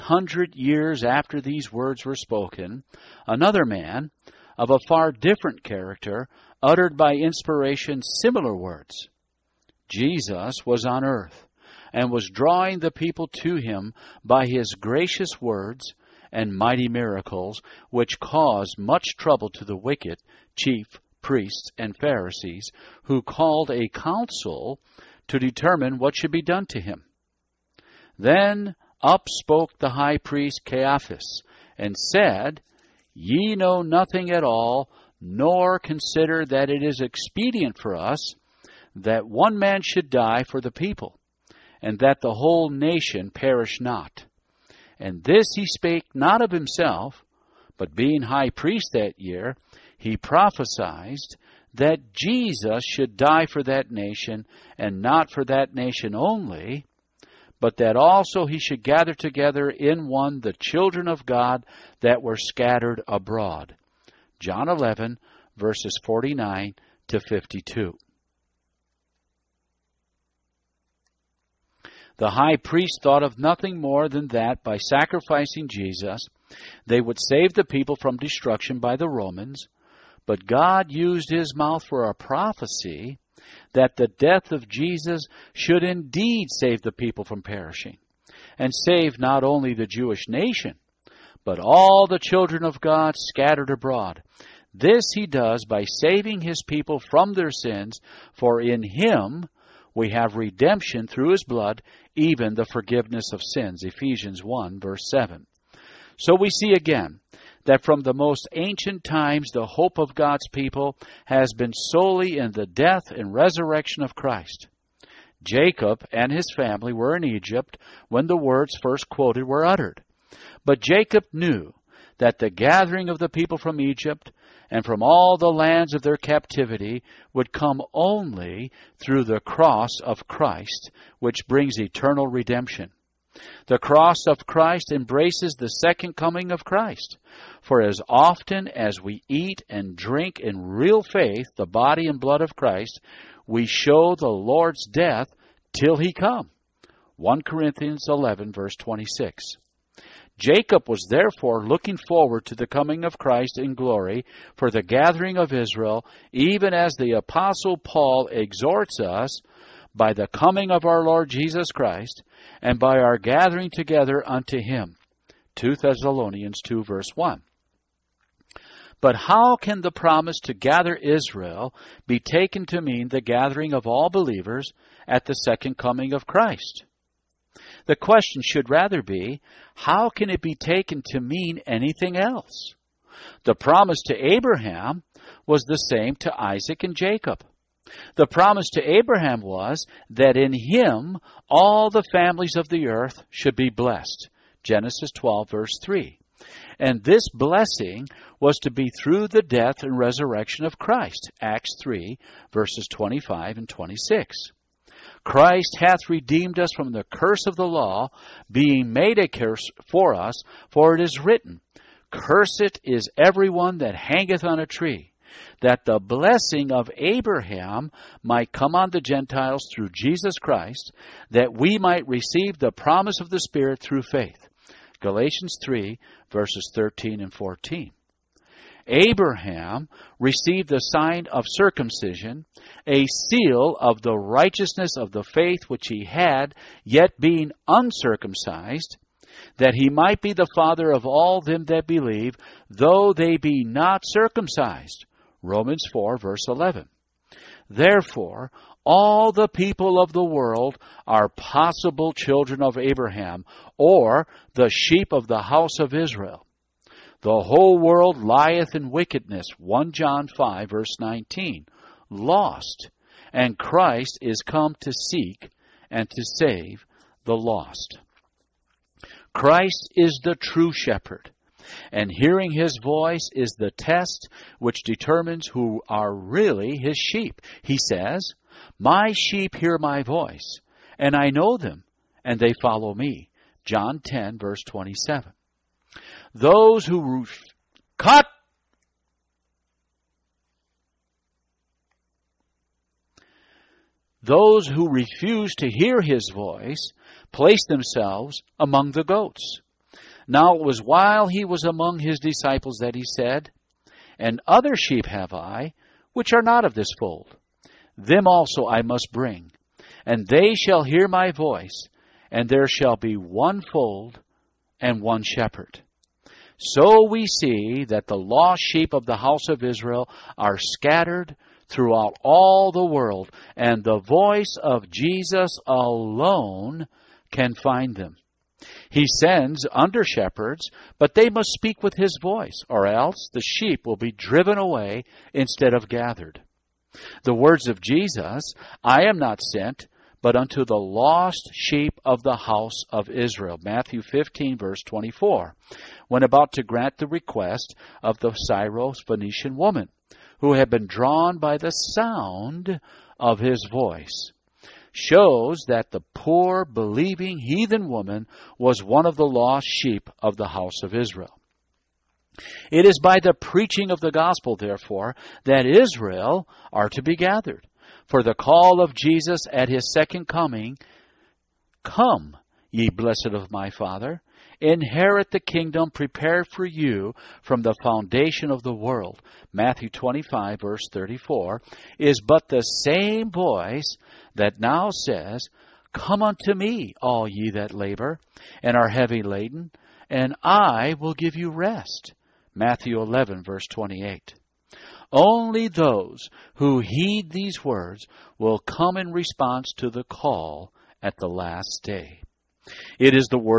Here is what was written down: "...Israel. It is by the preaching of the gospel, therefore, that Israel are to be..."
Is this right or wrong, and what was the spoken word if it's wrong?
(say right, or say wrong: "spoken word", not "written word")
right.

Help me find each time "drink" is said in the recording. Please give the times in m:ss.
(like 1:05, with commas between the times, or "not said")
2:19.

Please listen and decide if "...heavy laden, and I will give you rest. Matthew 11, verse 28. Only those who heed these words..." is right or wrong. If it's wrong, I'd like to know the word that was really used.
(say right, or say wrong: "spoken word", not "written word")
right.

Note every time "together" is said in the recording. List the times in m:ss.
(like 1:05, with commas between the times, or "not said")
0:59, 2:43.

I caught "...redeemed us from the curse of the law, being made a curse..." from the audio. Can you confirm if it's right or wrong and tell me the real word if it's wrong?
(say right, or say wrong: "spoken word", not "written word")
right.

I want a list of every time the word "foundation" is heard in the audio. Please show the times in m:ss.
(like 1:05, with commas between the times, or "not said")
6:17.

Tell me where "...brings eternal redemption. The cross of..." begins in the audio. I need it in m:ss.
2:11.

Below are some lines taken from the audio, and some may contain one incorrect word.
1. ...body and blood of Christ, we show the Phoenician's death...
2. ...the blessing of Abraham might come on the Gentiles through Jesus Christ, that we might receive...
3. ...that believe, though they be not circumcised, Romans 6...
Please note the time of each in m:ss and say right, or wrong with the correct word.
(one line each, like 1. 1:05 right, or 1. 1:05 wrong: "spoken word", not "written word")
1. 2:21 wrong: "Lord", not "Phoenician"
2. 3:35 right
3. 4:01 wrong: "4", not "6".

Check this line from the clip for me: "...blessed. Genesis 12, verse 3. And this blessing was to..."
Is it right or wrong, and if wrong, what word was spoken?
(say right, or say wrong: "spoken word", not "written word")
right.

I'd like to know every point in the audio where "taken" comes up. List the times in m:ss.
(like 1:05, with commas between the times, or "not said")
2:52, 3:00.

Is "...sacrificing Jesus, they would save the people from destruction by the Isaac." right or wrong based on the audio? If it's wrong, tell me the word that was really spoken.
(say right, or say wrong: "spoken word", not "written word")
wrong: "Romans", not "Isaac".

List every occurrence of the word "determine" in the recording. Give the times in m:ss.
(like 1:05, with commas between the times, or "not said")
0:25, 4:34.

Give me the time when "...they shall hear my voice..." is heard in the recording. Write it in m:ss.
5:10.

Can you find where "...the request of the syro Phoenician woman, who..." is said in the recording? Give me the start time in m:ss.
5:46.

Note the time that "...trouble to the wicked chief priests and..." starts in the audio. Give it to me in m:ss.
0:19.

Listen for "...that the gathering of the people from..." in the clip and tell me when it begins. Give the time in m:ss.
2:02.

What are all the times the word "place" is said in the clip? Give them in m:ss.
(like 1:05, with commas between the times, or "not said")
4:57.